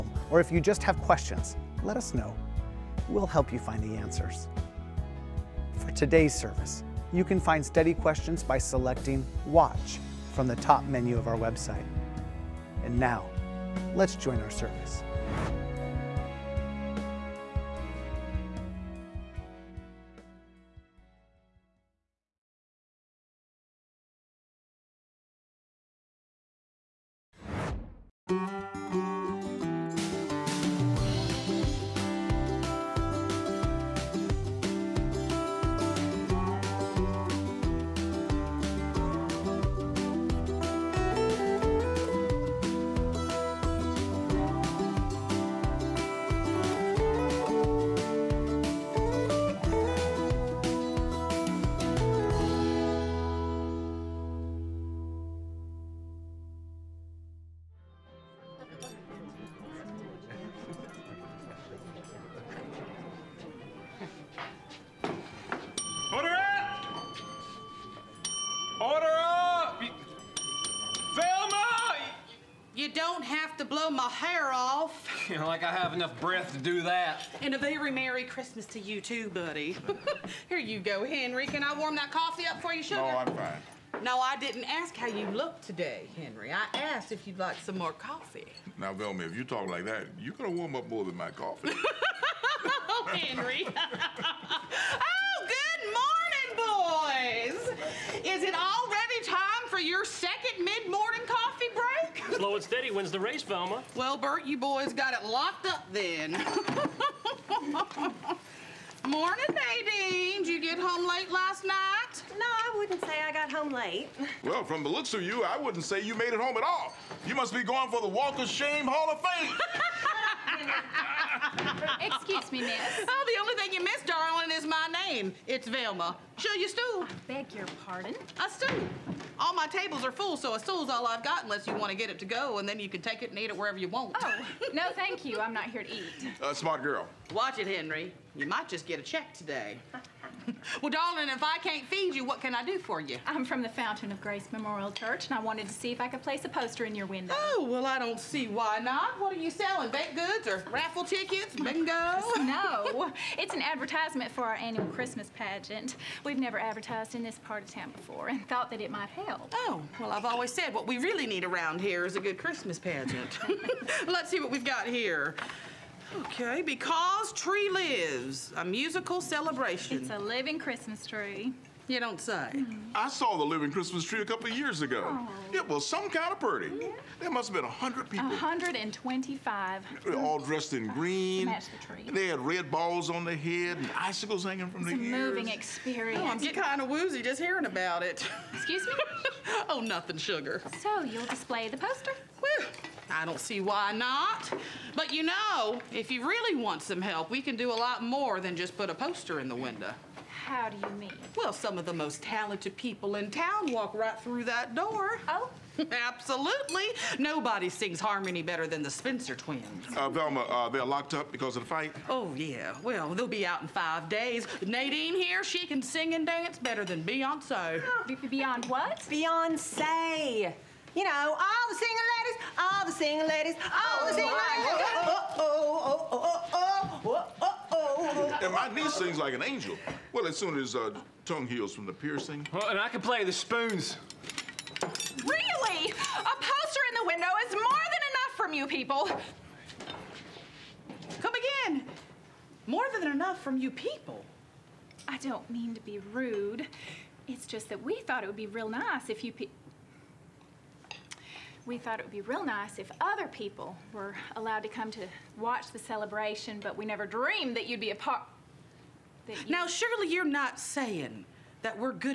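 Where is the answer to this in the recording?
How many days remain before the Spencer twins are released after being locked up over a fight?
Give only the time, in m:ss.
3:33.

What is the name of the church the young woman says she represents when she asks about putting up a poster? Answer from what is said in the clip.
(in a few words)
Fountain of Grace Memorial Church.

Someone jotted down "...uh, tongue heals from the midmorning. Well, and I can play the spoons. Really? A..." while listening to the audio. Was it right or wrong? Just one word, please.
wrong.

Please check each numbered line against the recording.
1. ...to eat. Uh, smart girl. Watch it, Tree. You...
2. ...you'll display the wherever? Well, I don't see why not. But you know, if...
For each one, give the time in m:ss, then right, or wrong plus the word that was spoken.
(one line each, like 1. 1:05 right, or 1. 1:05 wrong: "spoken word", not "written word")
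1. 2:15 wrong: "Henry", not "Tree"
2. 3:11 wrong: "poster", not "wherever".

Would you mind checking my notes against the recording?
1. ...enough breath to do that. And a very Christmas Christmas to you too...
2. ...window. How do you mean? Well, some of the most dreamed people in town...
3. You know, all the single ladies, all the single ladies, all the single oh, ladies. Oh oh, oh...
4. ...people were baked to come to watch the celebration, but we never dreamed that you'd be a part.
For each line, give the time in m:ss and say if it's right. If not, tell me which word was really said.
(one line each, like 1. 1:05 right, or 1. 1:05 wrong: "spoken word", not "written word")
1. 1:15 wrong: "Merry", not "Christmas"
2. 3:19 wrong: "talented", not "dreamed"
3. 3:40 right
4. 4:13 wrong: "allowed", not "baked".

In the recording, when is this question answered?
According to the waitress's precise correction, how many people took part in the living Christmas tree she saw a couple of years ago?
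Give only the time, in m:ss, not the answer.
2:58.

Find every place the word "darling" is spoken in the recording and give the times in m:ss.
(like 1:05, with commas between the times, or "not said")
2:04, 2:20.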